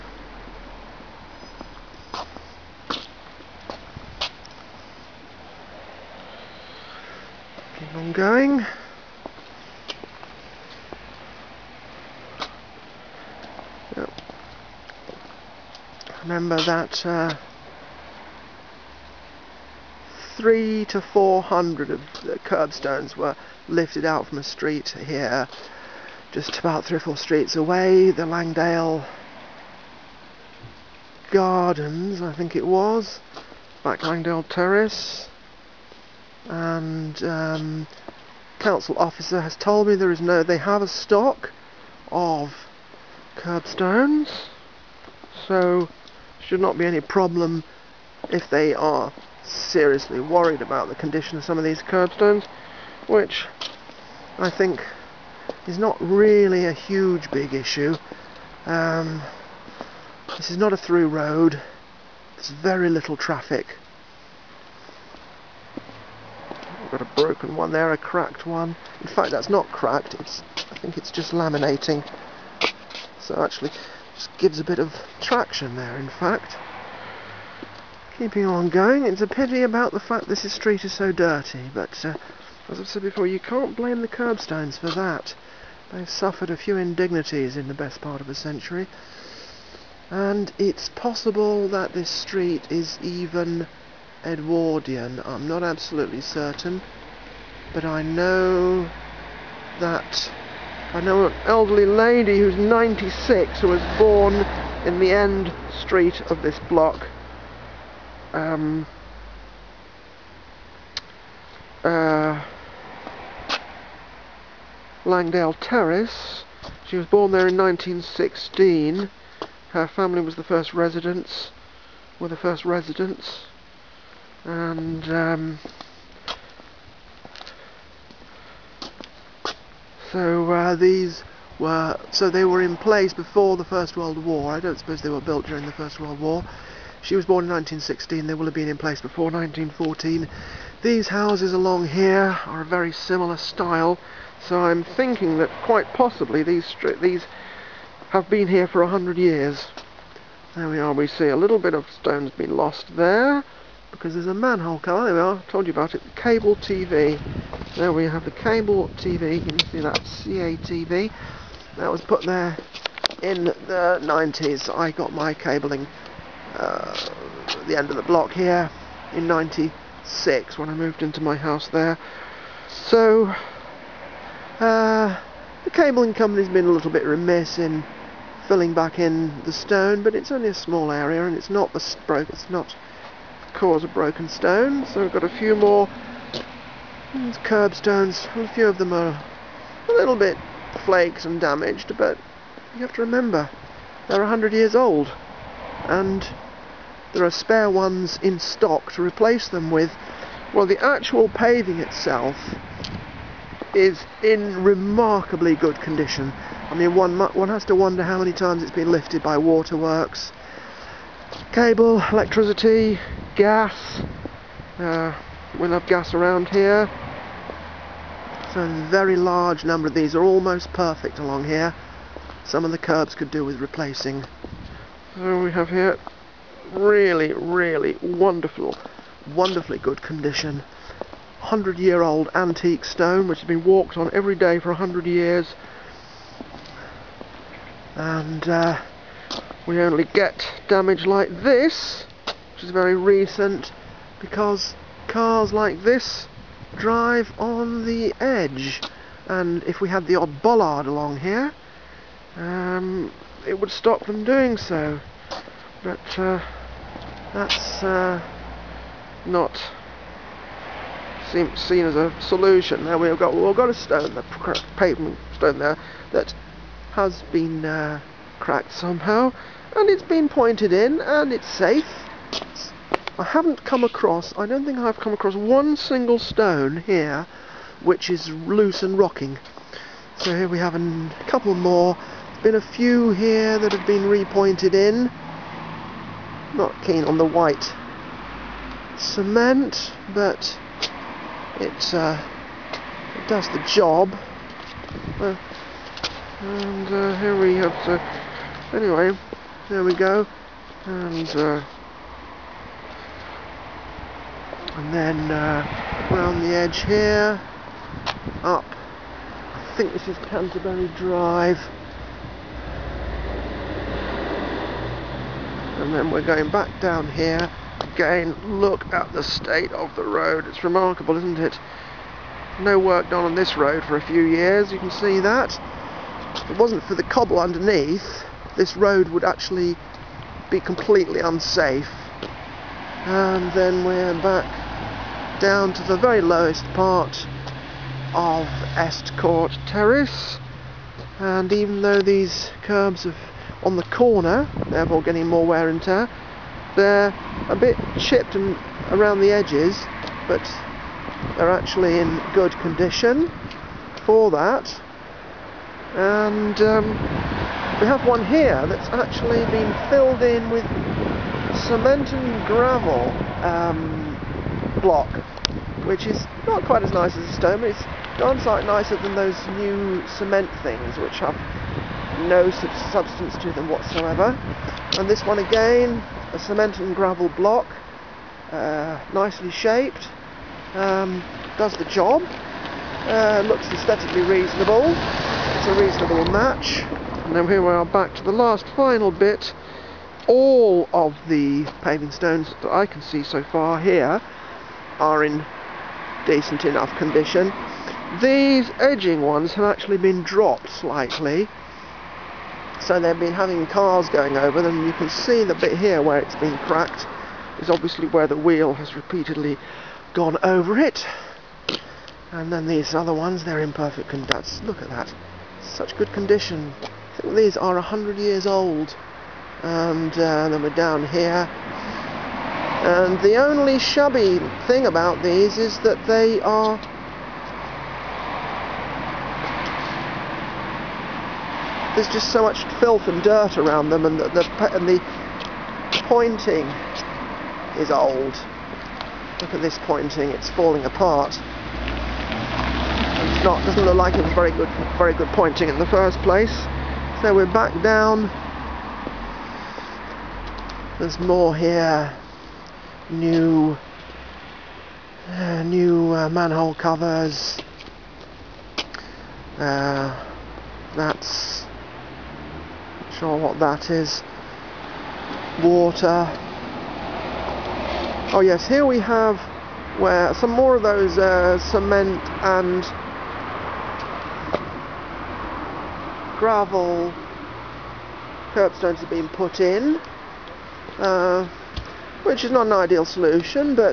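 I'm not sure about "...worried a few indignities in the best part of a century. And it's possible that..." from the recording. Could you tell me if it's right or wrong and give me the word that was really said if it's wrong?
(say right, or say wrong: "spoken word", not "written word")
wrong: "suffered", not "worried".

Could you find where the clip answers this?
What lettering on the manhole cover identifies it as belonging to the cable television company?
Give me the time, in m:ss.
2:39.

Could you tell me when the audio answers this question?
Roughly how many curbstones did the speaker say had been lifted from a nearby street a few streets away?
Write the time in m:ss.
0:20.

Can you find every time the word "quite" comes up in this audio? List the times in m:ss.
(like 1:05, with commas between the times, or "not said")
2:25, 6:06.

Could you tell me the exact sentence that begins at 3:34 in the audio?
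Uh, we'll have gas around here.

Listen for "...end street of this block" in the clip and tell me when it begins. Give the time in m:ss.
1:45.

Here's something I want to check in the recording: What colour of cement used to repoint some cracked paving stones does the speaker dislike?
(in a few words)
White.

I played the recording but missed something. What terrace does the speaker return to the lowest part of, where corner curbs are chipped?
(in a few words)
Estcourt Terrace.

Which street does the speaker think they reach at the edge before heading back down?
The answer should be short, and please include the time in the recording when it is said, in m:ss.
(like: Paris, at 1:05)
Canterbury Drive, at 5:10.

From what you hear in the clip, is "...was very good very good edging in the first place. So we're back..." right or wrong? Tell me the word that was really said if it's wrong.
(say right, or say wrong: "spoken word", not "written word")
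wrong: "pointing", not "edging".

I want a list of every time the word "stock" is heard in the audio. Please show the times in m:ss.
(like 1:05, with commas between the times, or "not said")
0:40, 3:18.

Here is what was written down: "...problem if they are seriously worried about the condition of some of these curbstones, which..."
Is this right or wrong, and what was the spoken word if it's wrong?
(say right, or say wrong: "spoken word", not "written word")
right.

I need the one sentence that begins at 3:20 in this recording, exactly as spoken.
Well, the actual paving itself is in remarkably good condition.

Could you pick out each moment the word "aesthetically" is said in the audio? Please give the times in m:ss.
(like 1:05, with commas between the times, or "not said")
6:23.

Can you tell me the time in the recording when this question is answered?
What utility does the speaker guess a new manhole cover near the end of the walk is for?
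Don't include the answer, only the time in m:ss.
7:45.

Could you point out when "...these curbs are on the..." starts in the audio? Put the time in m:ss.
5:41.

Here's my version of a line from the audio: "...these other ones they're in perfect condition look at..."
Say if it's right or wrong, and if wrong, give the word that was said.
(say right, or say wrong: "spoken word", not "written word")
right.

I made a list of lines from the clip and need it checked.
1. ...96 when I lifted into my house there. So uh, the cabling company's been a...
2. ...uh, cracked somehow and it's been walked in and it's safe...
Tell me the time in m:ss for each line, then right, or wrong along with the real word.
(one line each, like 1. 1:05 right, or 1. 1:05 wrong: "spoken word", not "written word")
1. 2:49 wrong: "moved", not "lifted"
2. 4:27 wrong: "pointed", not "walked".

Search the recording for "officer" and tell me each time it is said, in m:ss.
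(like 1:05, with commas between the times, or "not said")
0:38.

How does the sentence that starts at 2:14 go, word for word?
I don't suppose they were built during the First World War.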